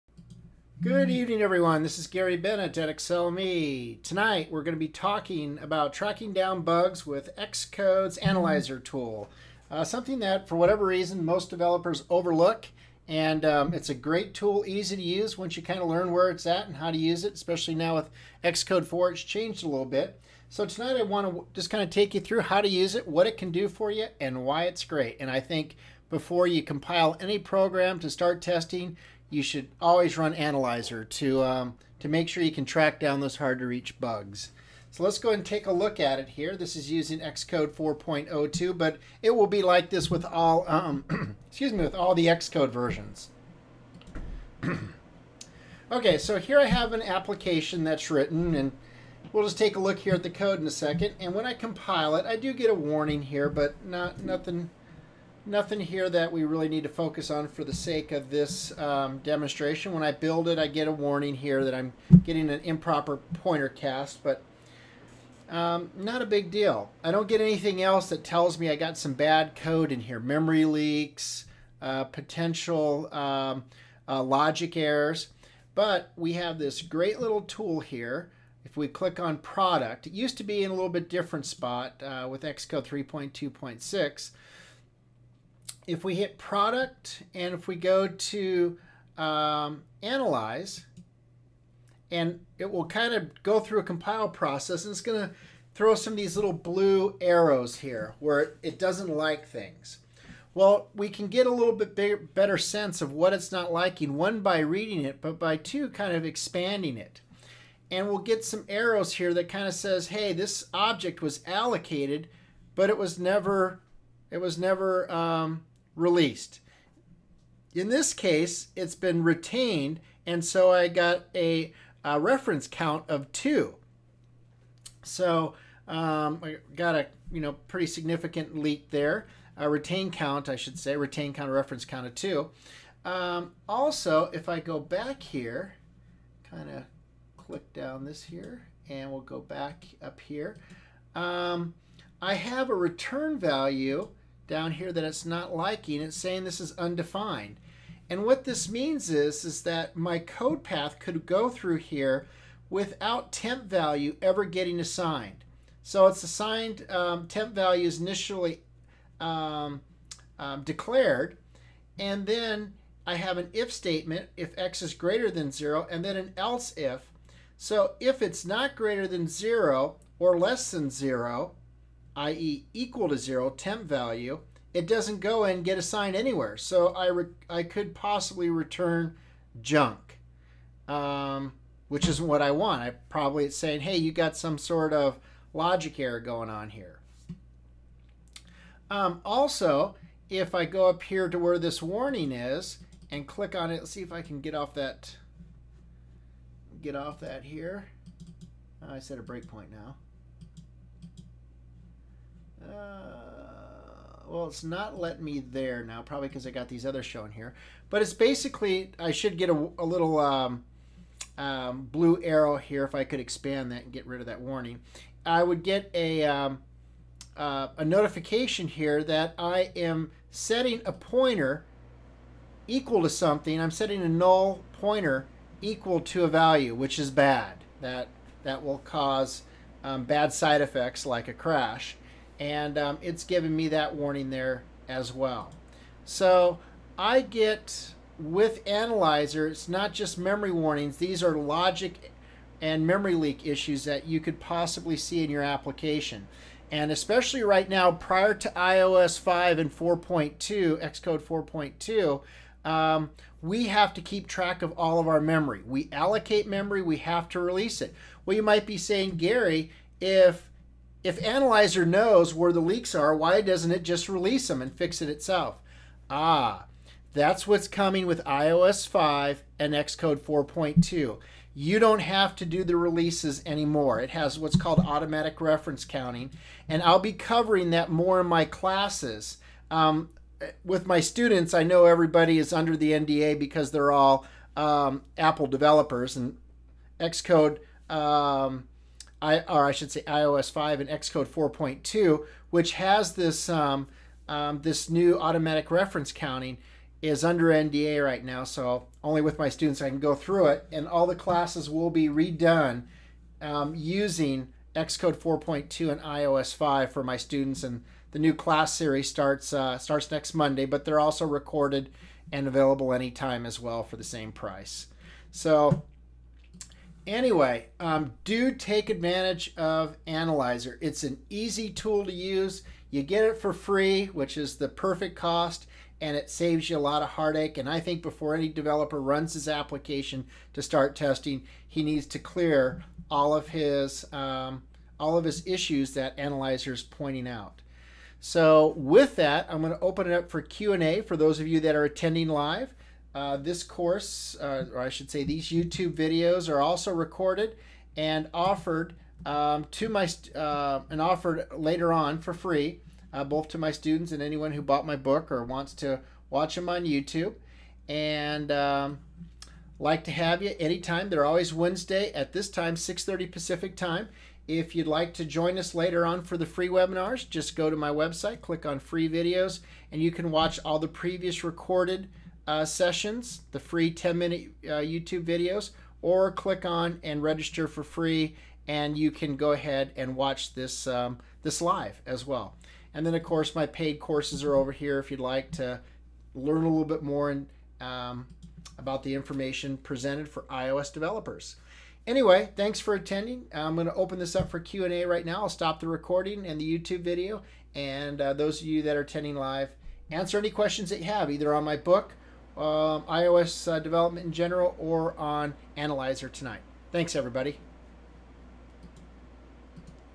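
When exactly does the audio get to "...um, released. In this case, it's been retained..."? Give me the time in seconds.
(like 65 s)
115 s.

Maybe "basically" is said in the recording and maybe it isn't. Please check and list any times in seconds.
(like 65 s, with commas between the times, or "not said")
208 s.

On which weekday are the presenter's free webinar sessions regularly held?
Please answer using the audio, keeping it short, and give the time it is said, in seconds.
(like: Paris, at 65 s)
Wednesday, at 361 s.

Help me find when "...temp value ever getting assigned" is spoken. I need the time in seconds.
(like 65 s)
153 s.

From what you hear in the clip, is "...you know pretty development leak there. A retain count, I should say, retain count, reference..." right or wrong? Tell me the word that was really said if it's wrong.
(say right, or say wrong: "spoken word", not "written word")
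wrong: "significant", not "development".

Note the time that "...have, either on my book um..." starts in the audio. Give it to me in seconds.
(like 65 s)
401 s.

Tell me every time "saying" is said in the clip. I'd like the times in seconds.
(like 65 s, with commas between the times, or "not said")
146 s, 183 s, 258 s.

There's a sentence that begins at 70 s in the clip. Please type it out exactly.
Memory leaks, uh, potential um, uh, logic errors.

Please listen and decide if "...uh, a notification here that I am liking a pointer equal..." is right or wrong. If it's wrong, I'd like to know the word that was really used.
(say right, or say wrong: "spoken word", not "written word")
wrong: "setting", not "liking".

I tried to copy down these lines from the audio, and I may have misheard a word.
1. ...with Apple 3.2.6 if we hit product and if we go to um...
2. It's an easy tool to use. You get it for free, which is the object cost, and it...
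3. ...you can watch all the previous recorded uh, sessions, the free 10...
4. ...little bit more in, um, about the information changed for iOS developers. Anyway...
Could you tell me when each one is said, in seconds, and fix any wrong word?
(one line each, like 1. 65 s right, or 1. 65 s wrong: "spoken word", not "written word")
1. 82 s wrong: "Xcode", not "Apple"
2. 320 s wrong: "perfect", not "object"
3. 370 s right
4. 386 s wrong: "presented", not "changed".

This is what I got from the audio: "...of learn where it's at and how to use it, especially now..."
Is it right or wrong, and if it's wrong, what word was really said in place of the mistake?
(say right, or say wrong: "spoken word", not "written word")
right.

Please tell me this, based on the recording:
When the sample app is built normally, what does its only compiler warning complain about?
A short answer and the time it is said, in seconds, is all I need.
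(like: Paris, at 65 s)
improper pointer cast, at 62 s.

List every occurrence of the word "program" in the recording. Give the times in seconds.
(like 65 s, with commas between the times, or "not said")
27 s.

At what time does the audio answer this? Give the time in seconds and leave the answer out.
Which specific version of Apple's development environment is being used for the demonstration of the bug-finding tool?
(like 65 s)
37 s.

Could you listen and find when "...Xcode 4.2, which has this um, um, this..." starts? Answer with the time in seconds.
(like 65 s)
290 s.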